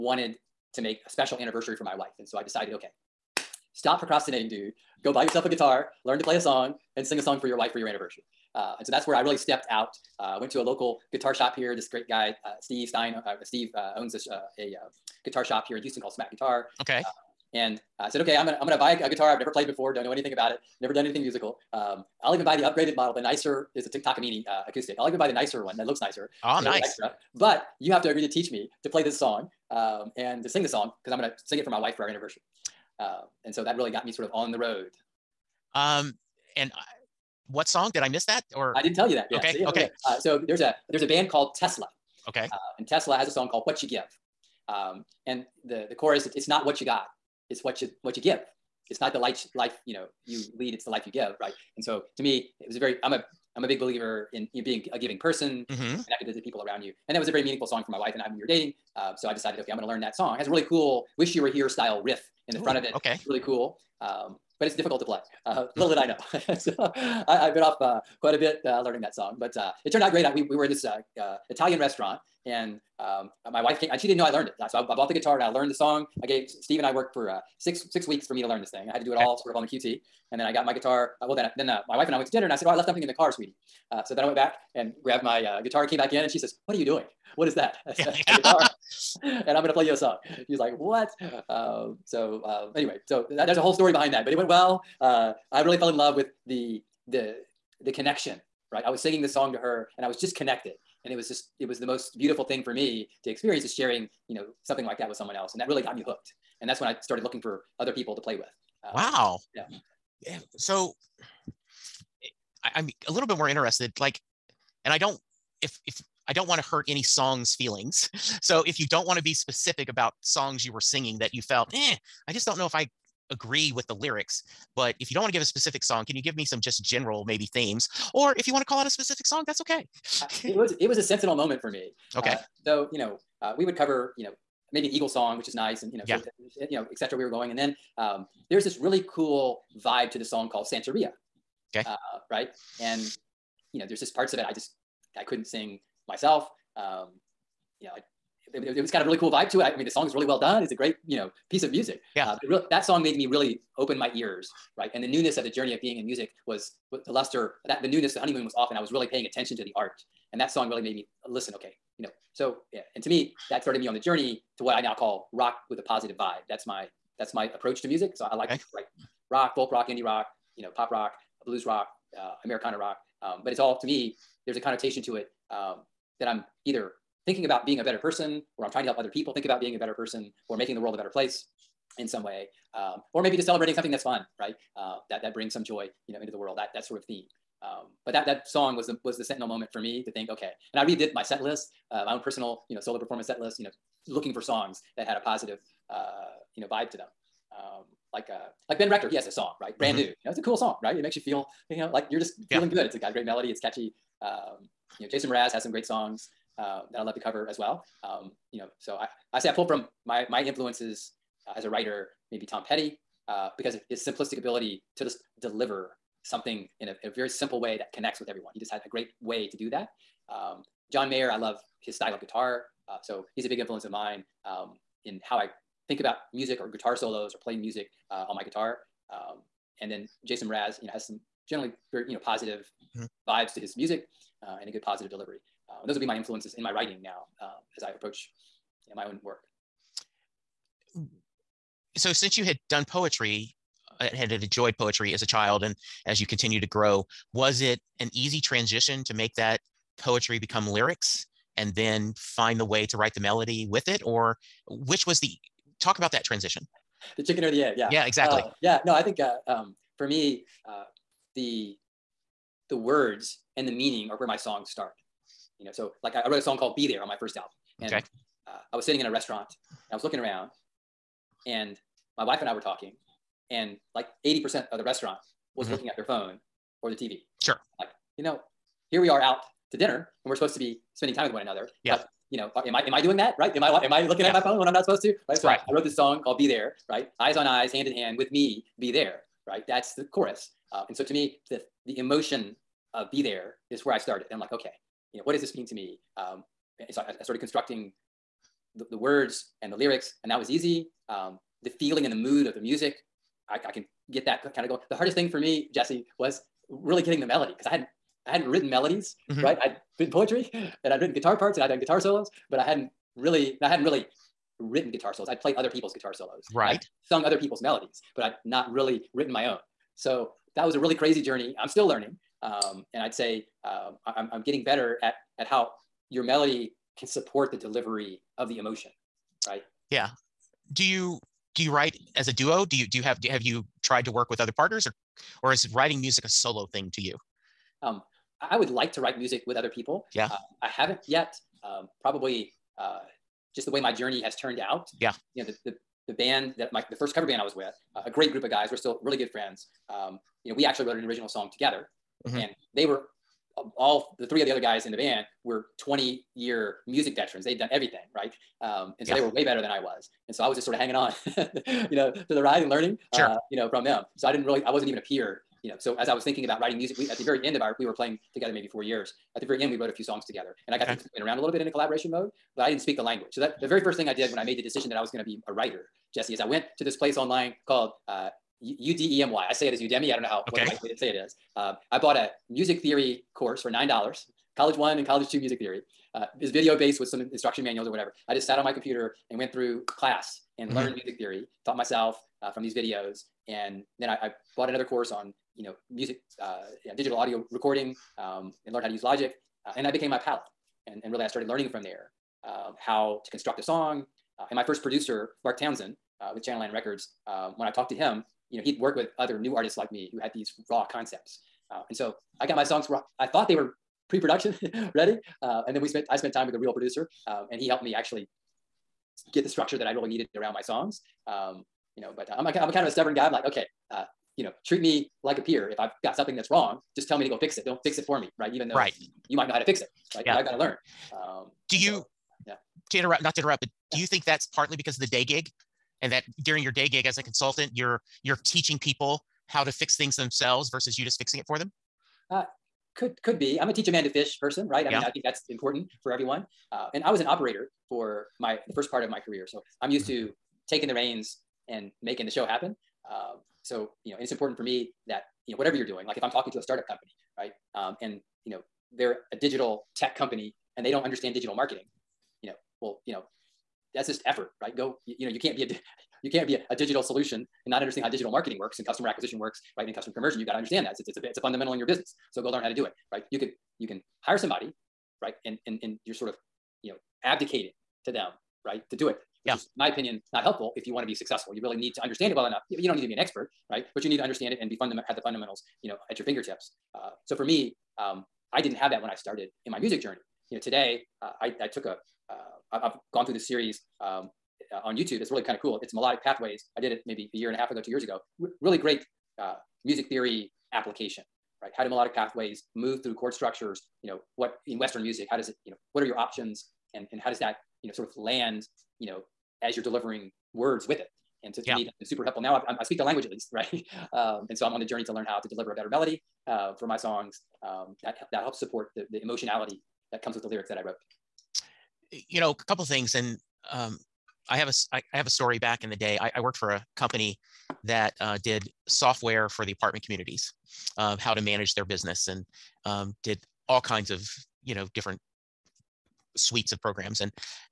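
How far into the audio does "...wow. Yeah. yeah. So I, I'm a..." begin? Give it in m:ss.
1:48.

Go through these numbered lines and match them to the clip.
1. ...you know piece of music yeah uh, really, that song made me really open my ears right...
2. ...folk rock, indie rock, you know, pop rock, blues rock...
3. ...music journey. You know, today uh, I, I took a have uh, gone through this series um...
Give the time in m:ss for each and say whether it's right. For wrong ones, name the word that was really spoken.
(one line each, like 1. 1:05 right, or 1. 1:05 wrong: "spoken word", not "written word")
1. 2:31 right
2. 2:49 right
3. 8:09 right.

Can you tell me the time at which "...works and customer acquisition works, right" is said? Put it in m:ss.
7:48.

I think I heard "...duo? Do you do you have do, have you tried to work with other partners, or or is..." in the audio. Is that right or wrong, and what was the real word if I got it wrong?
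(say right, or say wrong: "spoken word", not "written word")
right.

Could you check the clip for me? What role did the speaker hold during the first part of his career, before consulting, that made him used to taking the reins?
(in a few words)
Operator.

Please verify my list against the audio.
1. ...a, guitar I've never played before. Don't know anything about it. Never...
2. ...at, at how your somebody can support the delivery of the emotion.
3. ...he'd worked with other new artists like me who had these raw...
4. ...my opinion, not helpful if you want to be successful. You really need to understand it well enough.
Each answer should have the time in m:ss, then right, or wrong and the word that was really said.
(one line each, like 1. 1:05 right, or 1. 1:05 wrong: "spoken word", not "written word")
1. 0:19 right
2. 5:25 wrong: "melody", not "somebody"
3. 6:48 right
4. 7:59 right.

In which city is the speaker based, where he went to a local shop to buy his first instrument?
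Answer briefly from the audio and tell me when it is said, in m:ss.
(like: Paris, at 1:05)
Houston, at 0:15.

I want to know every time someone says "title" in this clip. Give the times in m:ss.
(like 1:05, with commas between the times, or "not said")
not said.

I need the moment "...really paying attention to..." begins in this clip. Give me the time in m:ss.
2:38.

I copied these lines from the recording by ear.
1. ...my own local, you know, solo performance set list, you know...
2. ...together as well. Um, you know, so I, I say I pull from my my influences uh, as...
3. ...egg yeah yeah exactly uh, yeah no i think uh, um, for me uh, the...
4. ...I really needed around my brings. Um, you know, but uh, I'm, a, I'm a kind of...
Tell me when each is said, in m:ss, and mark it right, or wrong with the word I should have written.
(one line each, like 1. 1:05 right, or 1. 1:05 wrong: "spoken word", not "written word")
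1. 3:12 wrong: "personal", not "local"
2. 3:27 wrong: "cover", not "together"
3. 4:17 right
4. 6:59 wrong: "songs", not "brings".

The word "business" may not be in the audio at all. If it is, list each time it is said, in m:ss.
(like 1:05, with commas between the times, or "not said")
7:51, 8:51.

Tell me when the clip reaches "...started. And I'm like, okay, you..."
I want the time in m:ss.
4:53.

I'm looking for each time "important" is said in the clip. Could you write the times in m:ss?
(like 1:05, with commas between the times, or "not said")
7:25, 7:34.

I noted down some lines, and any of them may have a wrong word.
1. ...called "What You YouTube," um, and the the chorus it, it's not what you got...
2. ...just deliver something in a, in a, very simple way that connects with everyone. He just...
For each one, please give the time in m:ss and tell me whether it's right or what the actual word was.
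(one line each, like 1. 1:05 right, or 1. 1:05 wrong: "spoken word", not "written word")
1. 0:43 wrong: "Give", not "YouTube"
2. 3:35 right.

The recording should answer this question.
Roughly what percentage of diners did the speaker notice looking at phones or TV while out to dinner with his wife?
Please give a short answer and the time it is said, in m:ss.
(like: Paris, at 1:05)
80%, at 4:34.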